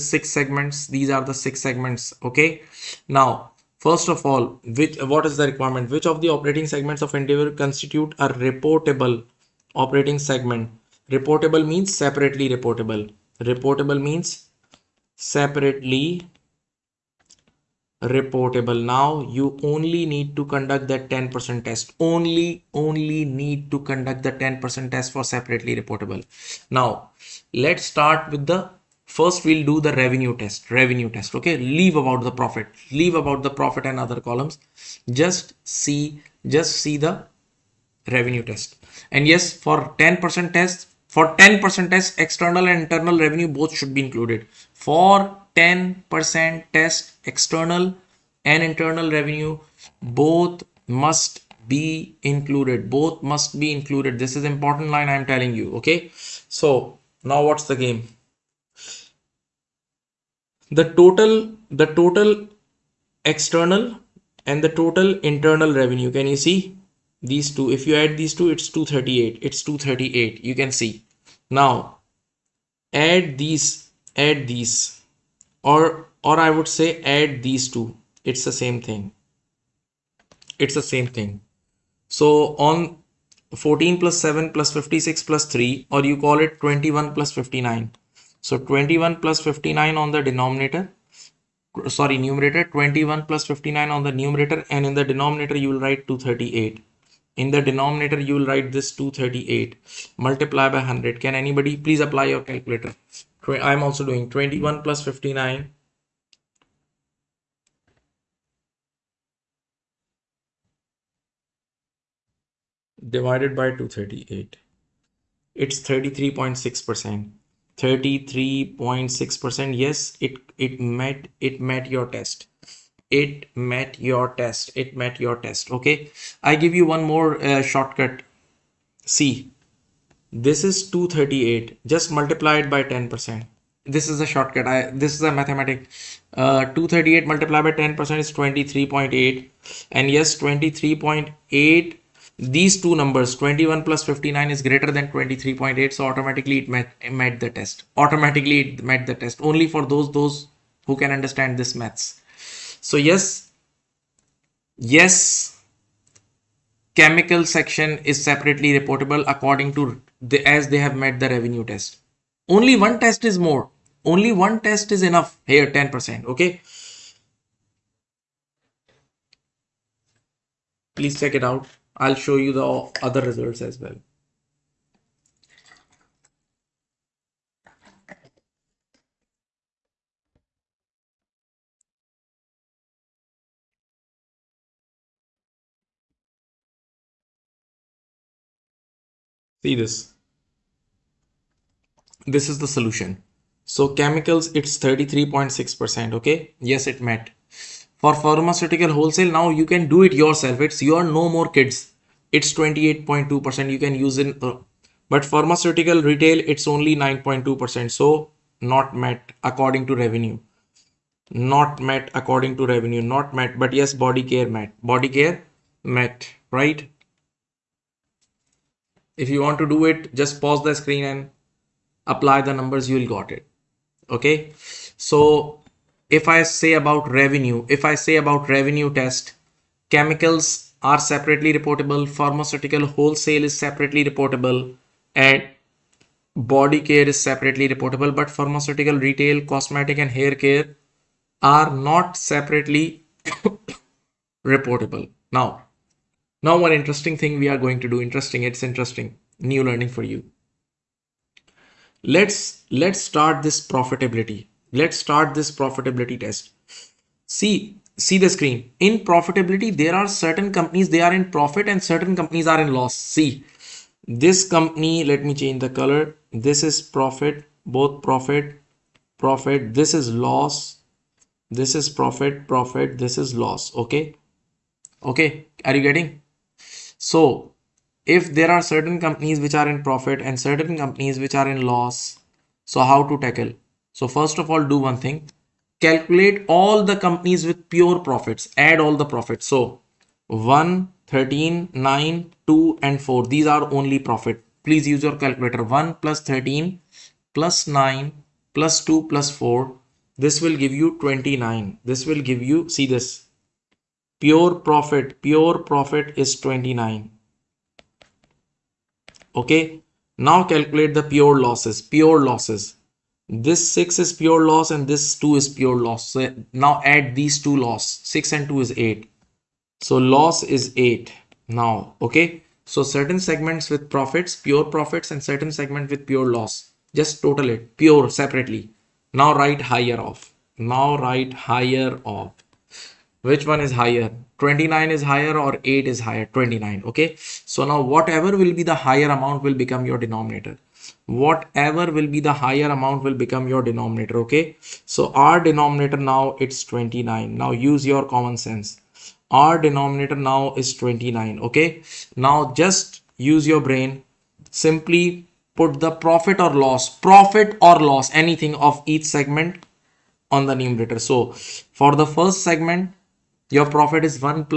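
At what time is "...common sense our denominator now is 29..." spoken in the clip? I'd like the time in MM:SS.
05:48.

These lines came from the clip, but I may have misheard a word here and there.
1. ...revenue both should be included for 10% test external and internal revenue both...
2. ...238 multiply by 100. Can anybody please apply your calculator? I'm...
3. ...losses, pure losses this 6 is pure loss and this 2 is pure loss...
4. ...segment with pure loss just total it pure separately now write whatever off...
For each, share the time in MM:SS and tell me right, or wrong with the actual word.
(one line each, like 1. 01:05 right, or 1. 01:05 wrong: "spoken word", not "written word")
1. 00:43 right
2. 01:38 right
3. 05:11 right
4. 05:25 wrong: "higher", not "whatever".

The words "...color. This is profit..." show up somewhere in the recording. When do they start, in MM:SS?
04:25.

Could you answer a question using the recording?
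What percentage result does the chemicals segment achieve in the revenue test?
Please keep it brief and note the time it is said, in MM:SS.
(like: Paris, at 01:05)
33.6%, at 01:55.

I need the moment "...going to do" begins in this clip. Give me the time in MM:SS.
04:07.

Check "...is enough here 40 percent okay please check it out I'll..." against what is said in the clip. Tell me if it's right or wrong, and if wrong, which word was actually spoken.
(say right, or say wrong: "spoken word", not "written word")
wrong: "10", not "40".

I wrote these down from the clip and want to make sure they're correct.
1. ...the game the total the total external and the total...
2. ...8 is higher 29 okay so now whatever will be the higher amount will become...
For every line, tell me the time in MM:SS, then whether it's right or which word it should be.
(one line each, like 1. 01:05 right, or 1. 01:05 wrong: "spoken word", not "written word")
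1. 00:57 right
2. 05:35 right.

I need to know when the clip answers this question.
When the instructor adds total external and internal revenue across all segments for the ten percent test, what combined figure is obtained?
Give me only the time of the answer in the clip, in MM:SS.
01:08.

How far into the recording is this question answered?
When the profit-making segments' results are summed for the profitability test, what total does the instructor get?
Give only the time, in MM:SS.
05:00.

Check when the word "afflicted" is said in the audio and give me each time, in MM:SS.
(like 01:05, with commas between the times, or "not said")
not said.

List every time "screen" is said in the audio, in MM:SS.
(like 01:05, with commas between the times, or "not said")
03:40, 04:18.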